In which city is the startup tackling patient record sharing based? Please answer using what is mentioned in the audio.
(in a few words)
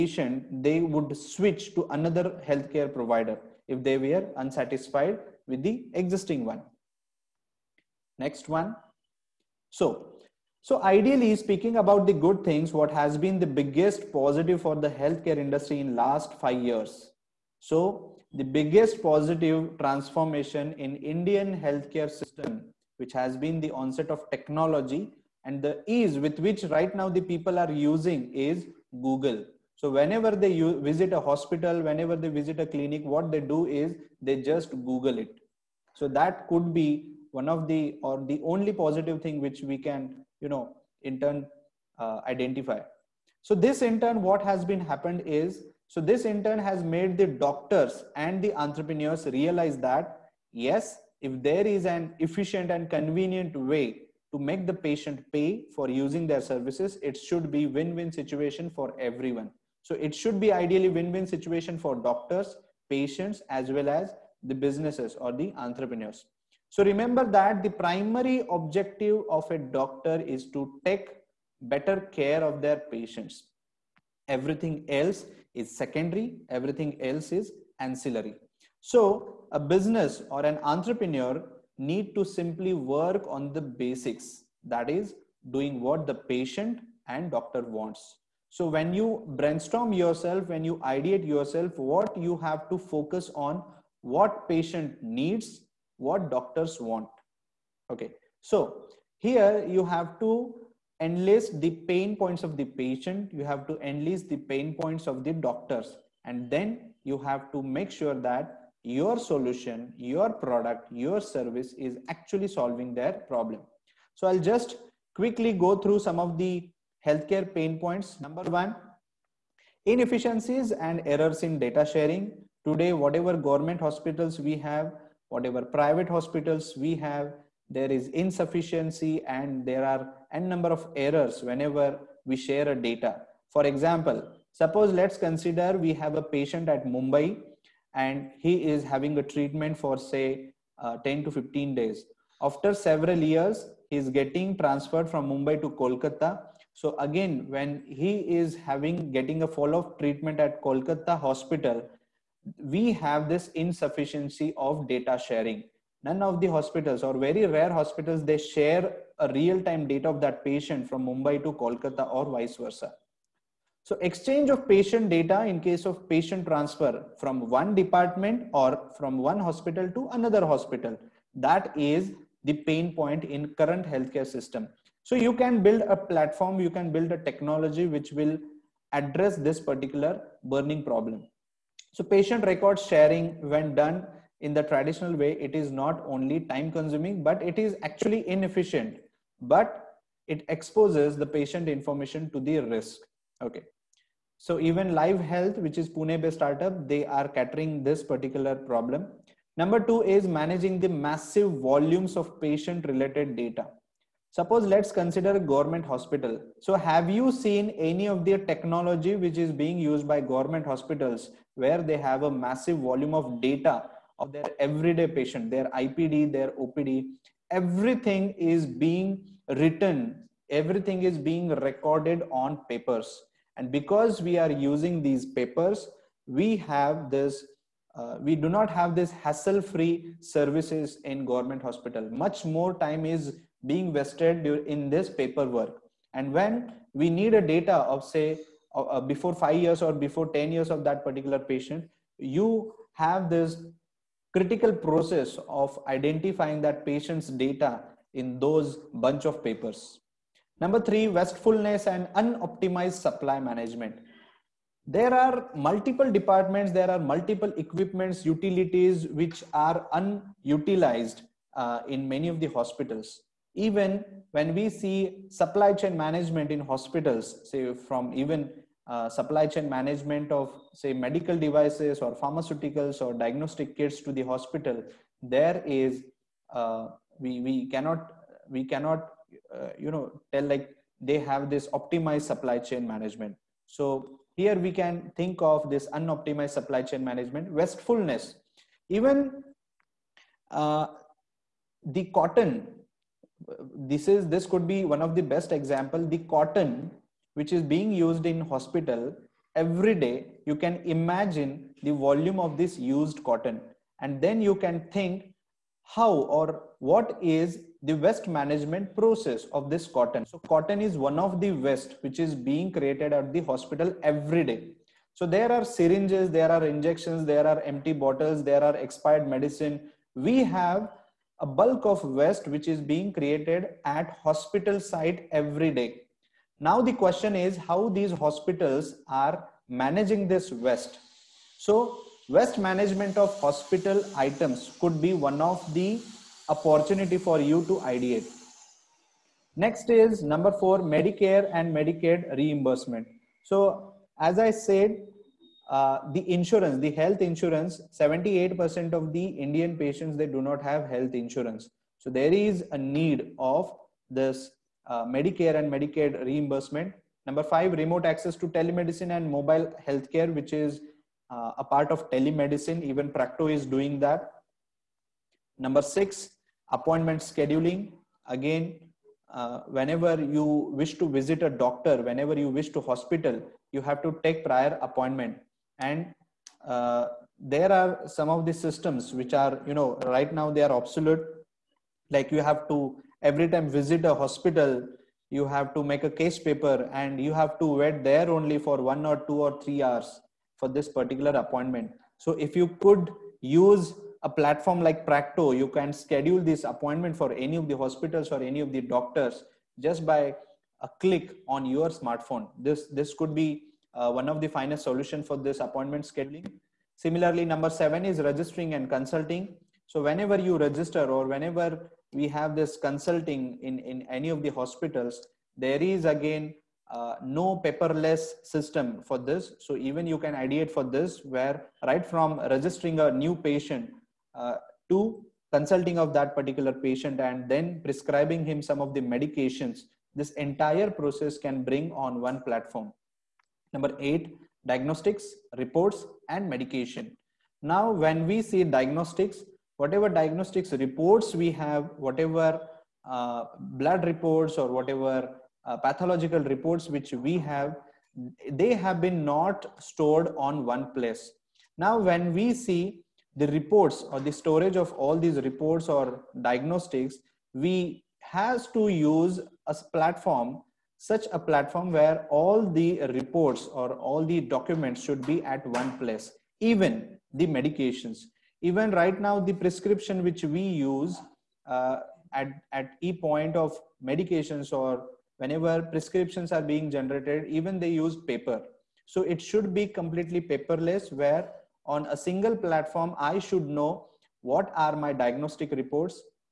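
Pune.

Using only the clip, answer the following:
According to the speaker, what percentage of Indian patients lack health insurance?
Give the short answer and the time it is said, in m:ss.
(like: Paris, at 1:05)
78%, at 5:47.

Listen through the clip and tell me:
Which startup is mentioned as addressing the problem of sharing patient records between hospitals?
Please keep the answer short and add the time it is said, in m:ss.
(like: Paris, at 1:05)
Live Health, at 3:14.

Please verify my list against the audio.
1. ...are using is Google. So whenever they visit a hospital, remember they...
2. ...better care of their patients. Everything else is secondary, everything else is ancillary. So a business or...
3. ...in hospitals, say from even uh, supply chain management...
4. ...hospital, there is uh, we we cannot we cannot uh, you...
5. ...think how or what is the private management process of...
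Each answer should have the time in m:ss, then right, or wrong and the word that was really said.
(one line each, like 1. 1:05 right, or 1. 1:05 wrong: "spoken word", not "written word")
1. 0:27 wrong: "whenever", not "remember"
2. 1:11 right
3. 4:26 right
4. 4:34 right
5. 5:04 wrong: "waste", not "private".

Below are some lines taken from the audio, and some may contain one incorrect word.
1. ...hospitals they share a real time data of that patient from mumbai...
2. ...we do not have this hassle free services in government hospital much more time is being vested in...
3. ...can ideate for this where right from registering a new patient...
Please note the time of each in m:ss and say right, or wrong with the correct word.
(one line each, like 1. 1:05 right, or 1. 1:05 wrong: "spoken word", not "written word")
1. 2:37 right
2. 3:48 right
3. 7:00 right.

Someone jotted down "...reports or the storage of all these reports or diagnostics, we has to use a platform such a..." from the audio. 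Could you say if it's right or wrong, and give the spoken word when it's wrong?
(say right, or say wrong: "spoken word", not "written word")
right.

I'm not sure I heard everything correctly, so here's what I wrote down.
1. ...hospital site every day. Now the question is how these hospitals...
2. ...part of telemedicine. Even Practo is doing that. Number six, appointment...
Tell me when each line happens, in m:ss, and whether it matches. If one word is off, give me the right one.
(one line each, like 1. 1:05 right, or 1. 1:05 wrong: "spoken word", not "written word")
1. 5:24 right
2. 6:01 right.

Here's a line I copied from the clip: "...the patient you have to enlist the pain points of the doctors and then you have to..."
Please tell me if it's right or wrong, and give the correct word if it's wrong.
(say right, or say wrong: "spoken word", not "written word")
right.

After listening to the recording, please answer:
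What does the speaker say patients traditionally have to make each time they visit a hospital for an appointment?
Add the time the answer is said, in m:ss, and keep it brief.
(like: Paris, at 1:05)
A case paper, at 6:26.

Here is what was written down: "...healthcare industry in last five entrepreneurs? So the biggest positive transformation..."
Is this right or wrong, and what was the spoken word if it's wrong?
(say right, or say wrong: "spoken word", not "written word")
wrong: "years", not "entrepreneurs".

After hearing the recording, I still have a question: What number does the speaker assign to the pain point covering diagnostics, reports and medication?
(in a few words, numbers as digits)
8.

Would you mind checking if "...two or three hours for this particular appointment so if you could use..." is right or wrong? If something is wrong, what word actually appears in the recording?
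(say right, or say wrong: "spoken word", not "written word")
right.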